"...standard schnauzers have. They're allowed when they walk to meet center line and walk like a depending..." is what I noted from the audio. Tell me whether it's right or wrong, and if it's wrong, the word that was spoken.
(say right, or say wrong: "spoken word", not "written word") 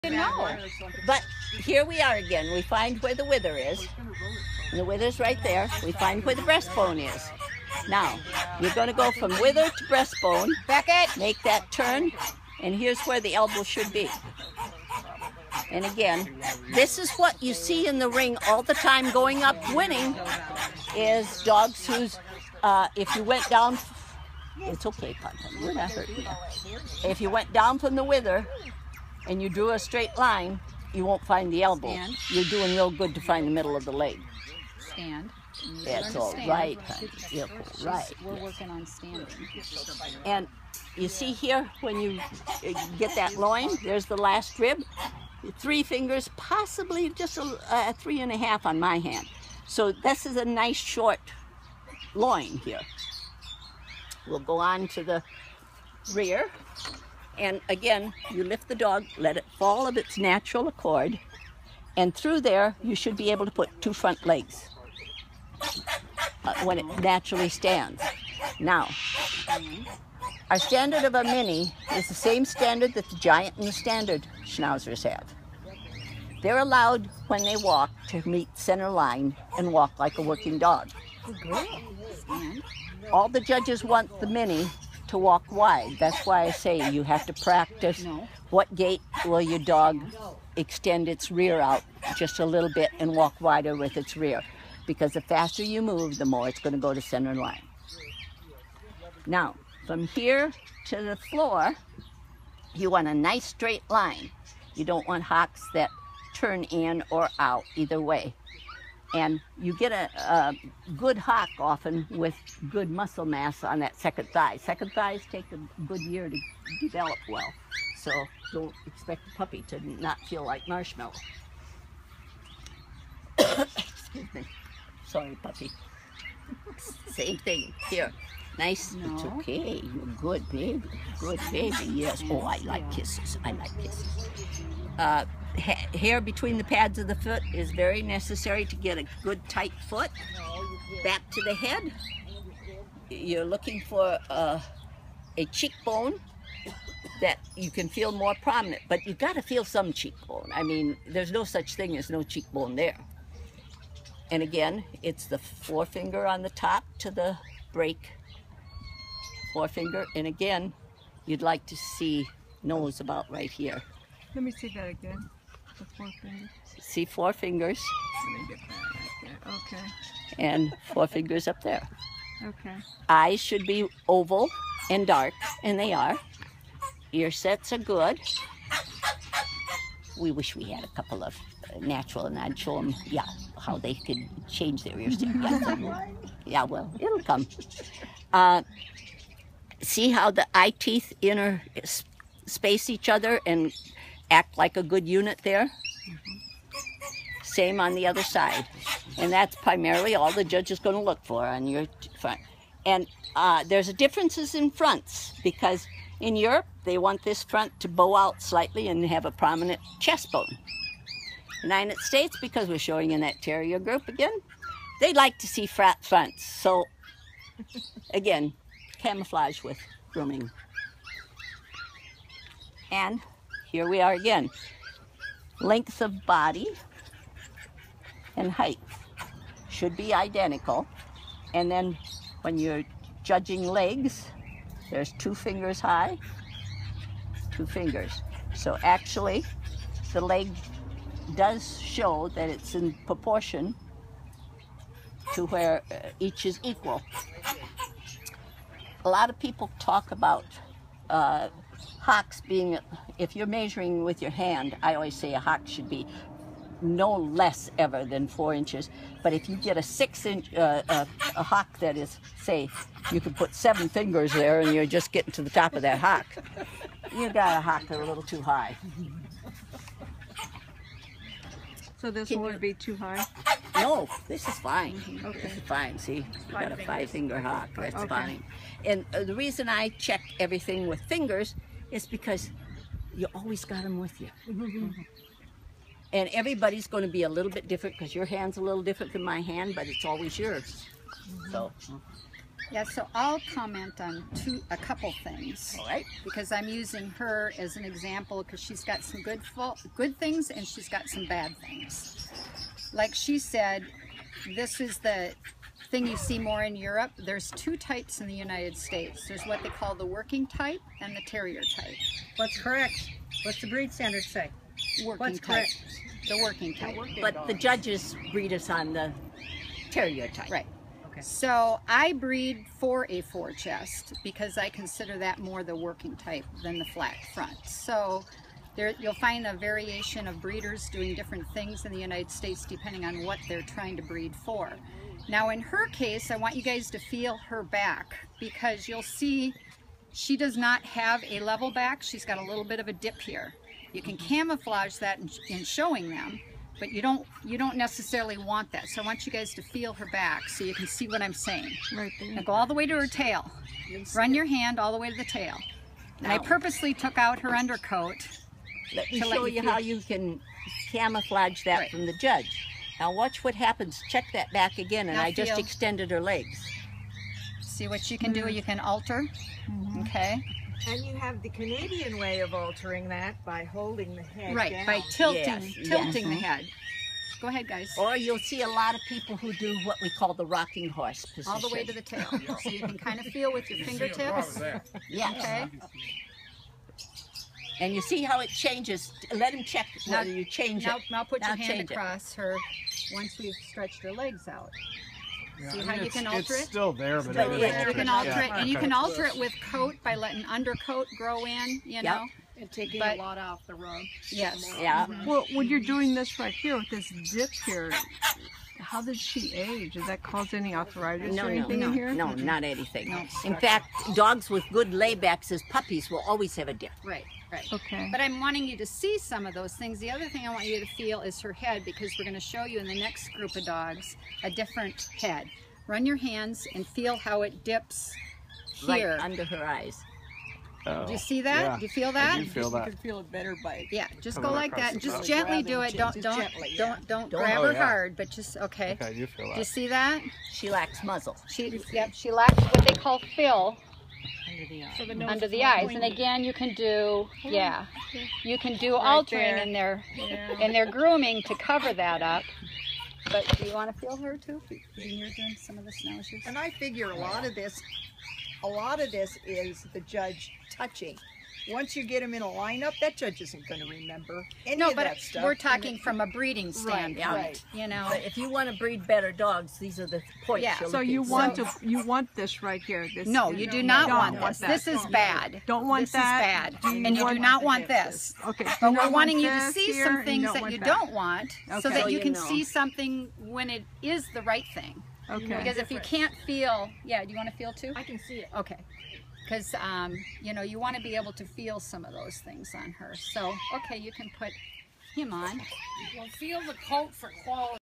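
wrong: "working", not "depending".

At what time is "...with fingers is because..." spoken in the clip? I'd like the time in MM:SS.
04:40.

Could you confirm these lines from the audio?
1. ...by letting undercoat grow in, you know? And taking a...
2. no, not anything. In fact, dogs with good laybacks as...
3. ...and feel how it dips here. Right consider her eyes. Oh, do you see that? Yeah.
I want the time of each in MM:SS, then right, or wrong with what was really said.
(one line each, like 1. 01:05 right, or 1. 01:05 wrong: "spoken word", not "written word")
1. 06:40 right
2. 06:52 right
3. 07:06 wrong: "under", not "consider".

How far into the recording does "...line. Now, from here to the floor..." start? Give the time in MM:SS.
01:37.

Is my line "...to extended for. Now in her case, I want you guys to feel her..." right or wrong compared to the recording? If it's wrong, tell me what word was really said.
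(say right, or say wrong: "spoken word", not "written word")
wrong: "breed", not "extended".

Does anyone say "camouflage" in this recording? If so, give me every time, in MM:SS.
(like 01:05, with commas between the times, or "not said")
03:39, 05:44, 06:00.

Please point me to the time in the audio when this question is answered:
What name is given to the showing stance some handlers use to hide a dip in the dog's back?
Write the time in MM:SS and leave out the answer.
06:20.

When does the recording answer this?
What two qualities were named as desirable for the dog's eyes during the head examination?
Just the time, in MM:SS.
02:54.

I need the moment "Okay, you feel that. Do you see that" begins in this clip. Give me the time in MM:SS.
07:18.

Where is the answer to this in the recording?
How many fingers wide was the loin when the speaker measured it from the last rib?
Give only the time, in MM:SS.
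00:45.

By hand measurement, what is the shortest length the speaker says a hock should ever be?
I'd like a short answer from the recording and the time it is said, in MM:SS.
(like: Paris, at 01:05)
4 inches, at 04:18.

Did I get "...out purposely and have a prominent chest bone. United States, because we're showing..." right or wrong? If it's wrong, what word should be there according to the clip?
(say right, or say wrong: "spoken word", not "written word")
wrong: "slightly", not "purposely".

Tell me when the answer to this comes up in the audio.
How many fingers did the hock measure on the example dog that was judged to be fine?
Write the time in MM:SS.
04:36.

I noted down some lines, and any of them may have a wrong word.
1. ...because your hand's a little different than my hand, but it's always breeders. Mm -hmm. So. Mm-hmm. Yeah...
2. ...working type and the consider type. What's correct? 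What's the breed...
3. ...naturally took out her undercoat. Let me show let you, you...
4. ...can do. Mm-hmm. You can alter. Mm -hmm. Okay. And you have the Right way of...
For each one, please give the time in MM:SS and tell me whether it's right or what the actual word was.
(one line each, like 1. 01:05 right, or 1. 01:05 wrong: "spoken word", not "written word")
1. 04:47 wrong: "yours", not "breeders"
2. 05:10 wrong: "terrier", not "consider"
3. 05:56 wrong: "purposely", not "naturally"
4. 06:08 wrong: "Canadian", not "Right".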